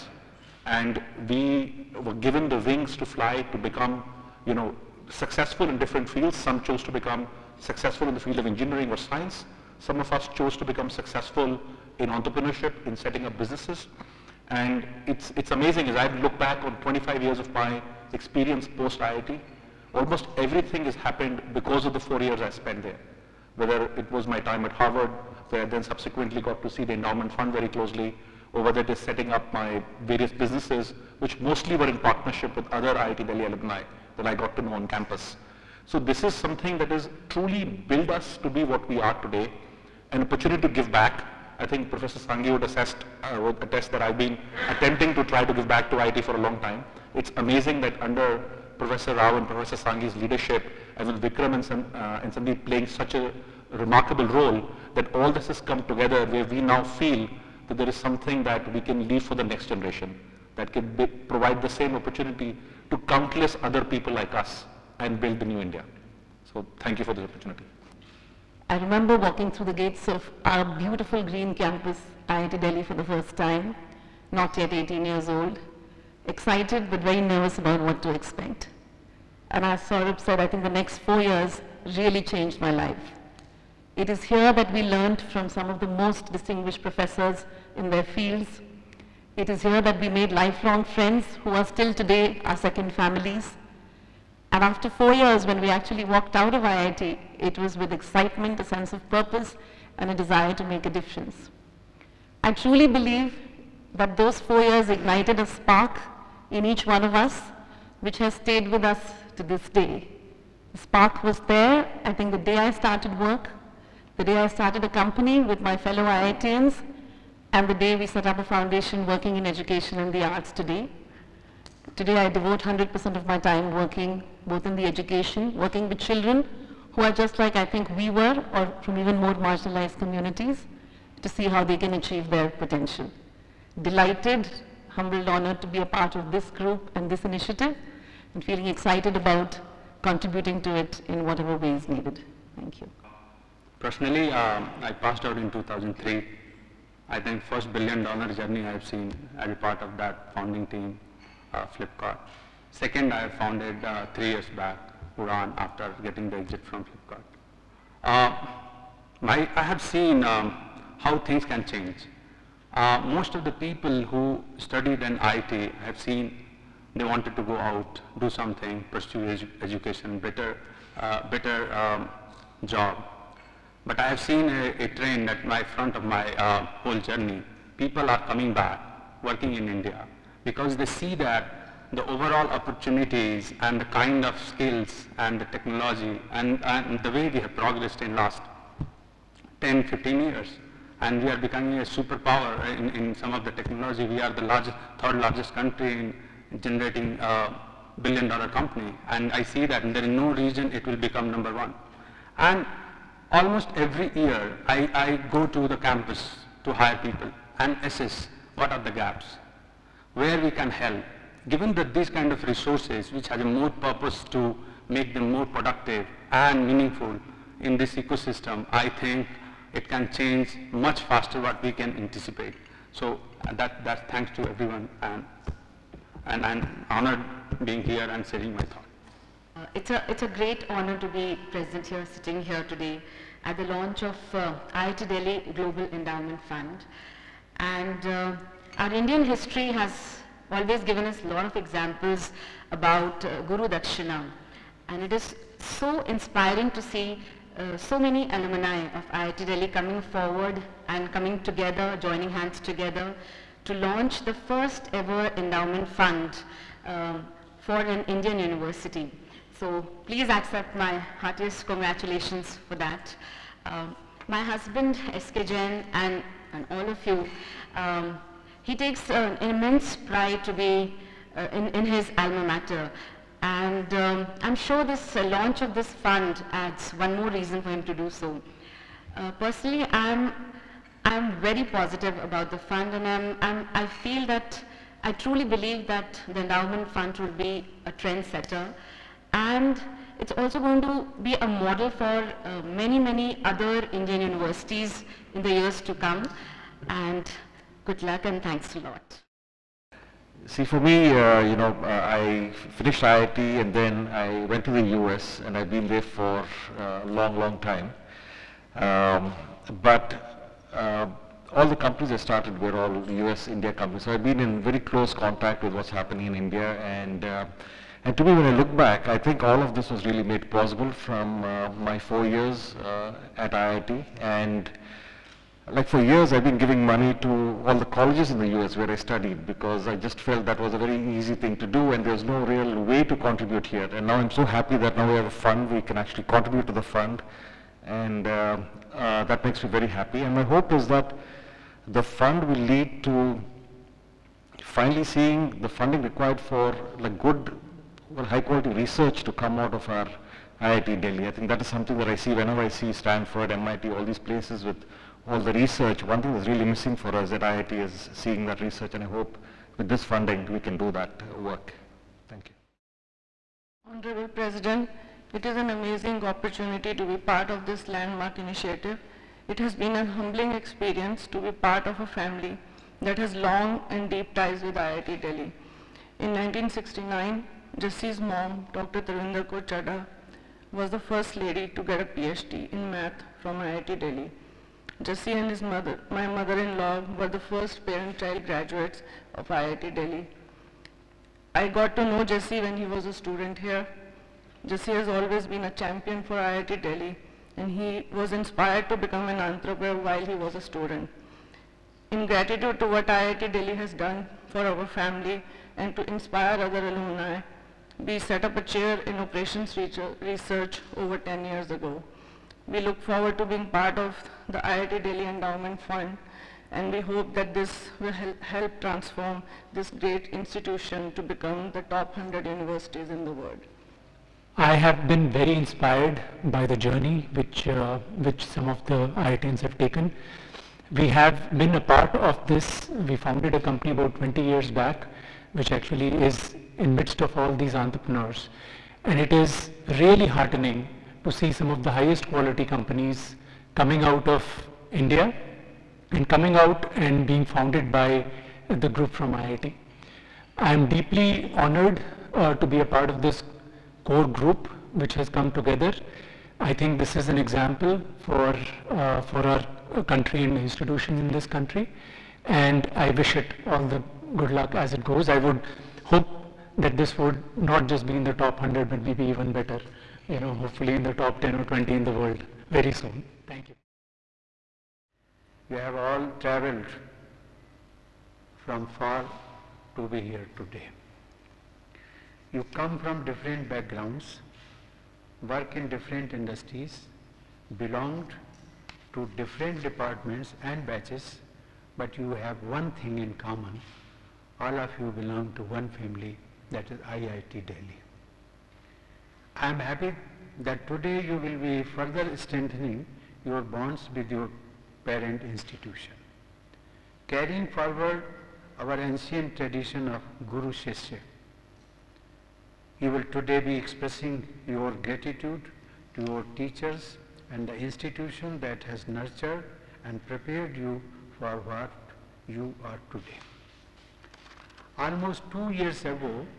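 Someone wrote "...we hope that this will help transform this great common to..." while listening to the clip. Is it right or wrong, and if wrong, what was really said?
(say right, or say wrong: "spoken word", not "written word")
wrong: "institution", not "common".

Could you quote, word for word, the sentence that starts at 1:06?
So thank you for this opportunity.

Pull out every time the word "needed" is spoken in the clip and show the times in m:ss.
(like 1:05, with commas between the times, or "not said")
2:21.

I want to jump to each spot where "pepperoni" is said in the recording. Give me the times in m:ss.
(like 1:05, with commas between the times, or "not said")
not said.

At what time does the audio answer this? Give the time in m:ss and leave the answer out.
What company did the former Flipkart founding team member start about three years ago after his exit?
2:35.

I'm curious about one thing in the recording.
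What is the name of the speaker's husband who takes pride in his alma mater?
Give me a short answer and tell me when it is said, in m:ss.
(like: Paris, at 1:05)
S.K. Jain, at 4:25.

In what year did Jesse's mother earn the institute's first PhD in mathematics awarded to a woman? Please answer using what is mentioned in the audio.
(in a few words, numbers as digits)
1969.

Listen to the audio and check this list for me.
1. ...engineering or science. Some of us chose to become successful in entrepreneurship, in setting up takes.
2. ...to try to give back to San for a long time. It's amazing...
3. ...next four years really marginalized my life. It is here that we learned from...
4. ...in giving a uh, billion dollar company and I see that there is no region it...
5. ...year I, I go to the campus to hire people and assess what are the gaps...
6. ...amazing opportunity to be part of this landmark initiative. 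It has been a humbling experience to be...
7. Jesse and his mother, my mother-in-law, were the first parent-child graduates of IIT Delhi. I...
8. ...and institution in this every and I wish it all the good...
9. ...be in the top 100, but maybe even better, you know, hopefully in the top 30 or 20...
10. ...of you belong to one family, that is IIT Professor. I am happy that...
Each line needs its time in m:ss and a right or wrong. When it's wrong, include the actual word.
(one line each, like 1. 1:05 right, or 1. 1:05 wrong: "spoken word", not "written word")
1. 0:08 wrong: "businesses", not "takes"
2. 0:45 wrong: "IIT", not "San"
3. 1:20 wrong: "changed", not "marginalized"
4. 3:16 wrong: "generating", not "giving"
5. 3:24 right
6. 6:05 right
7. 6:25 right
8. 7:40 wrong: "country", not "every"
9. 7:48 wrong: "10", not "30"
10. 8:14 wrong: "Delhi", not "Professor".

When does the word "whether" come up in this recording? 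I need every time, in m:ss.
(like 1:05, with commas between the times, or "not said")
0:23, 0:28.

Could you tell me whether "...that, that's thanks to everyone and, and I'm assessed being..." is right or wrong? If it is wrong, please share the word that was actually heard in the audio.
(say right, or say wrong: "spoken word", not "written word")
wrong: "honored", not "assessed".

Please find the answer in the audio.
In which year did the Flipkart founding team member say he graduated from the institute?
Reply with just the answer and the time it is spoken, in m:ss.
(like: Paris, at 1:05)
2003, at 2:25.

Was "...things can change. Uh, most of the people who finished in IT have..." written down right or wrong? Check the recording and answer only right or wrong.
wrong.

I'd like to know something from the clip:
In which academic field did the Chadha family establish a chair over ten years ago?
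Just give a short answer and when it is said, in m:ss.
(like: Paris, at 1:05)
Operations research, at 6:49.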